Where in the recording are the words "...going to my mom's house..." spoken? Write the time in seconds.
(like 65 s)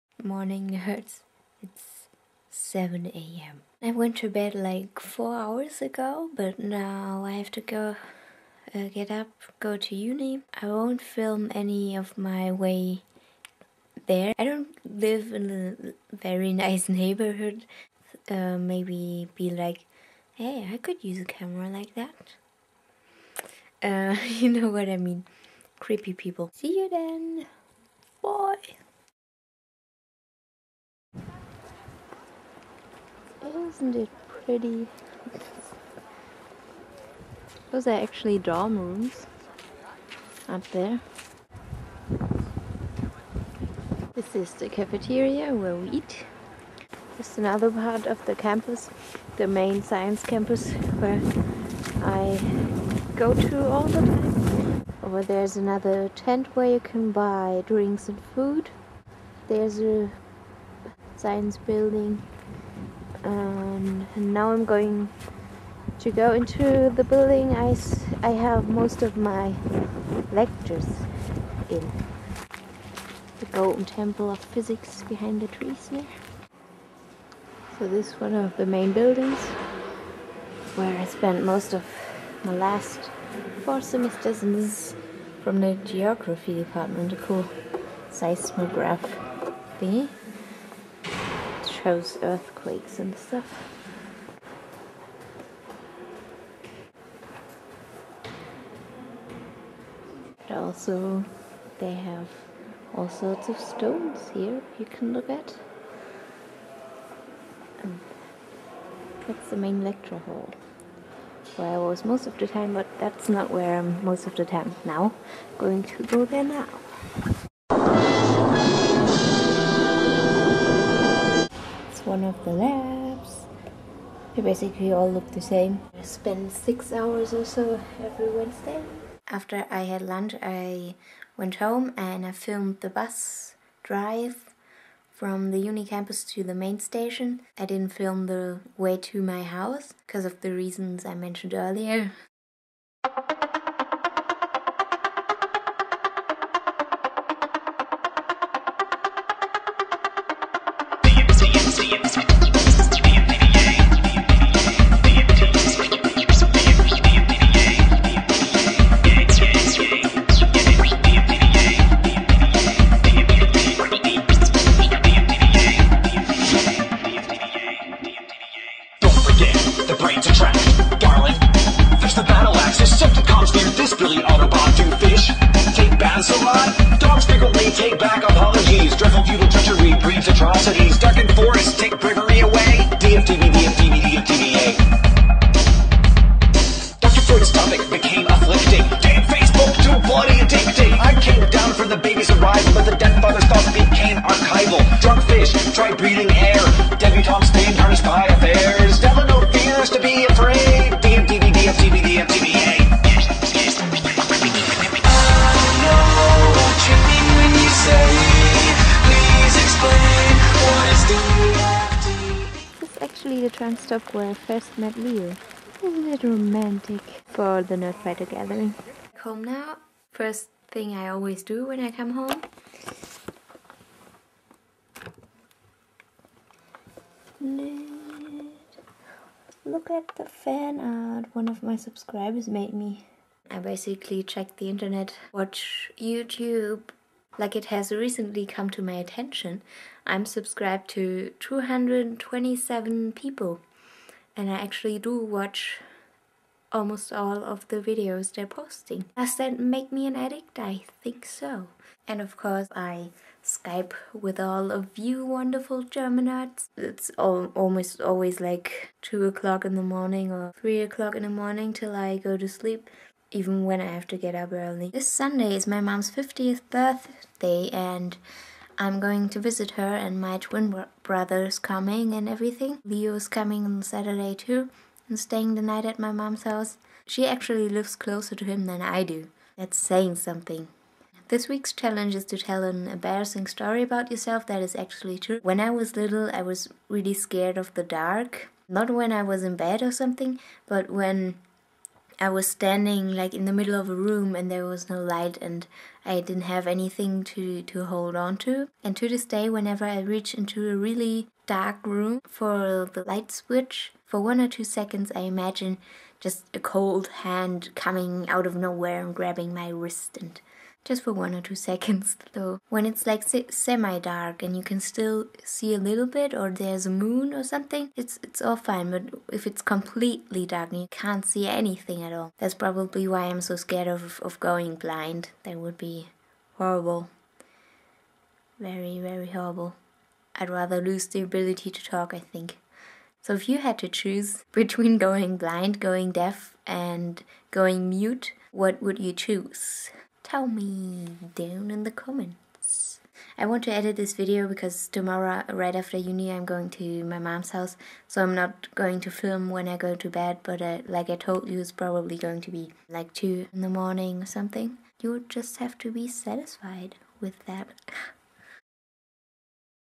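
346 s.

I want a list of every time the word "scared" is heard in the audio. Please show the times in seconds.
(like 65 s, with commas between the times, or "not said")
287 s, 323 s.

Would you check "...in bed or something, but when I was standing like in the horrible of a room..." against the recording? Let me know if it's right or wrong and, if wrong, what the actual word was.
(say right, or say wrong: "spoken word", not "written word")
wrong: "middle", not "horrible".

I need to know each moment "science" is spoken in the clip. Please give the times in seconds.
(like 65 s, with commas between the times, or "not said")
49 s, 61 s.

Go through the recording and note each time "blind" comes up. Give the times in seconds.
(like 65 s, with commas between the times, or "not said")
324 s, 335 s.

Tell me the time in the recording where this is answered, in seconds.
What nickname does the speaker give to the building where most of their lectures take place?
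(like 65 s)
73 s.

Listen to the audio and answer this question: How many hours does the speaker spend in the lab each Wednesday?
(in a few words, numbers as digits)
6.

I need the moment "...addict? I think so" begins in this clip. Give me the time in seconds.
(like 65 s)
250 s.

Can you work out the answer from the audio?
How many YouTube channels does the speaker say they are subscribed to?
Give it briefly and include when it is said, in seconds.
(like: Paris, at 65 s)
227, at 241 s.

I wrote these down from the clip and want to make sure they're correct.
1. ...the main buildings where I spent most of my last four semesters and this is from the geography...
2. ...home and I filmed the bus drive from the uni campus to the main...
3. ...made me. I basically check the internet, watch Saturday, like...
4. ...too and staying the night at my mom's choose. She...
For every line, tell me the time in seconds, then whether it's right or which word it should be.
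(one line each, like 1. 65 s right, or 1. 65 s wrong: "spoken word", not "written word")
1. 78 s right
2. 131 s right
3. 232 s wrong: "YouTube", not "Saturday"
4. 274 s wrong: "house", not "choose".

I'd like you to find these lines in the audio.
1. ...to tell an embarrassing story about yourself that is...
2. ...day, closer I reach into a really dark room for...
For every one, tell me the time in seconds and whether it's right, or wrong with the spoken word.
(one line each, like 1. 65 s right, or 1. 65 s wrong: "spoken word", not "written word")
1. 282 s right
2. 299 s wrong: "whenever", not "closer".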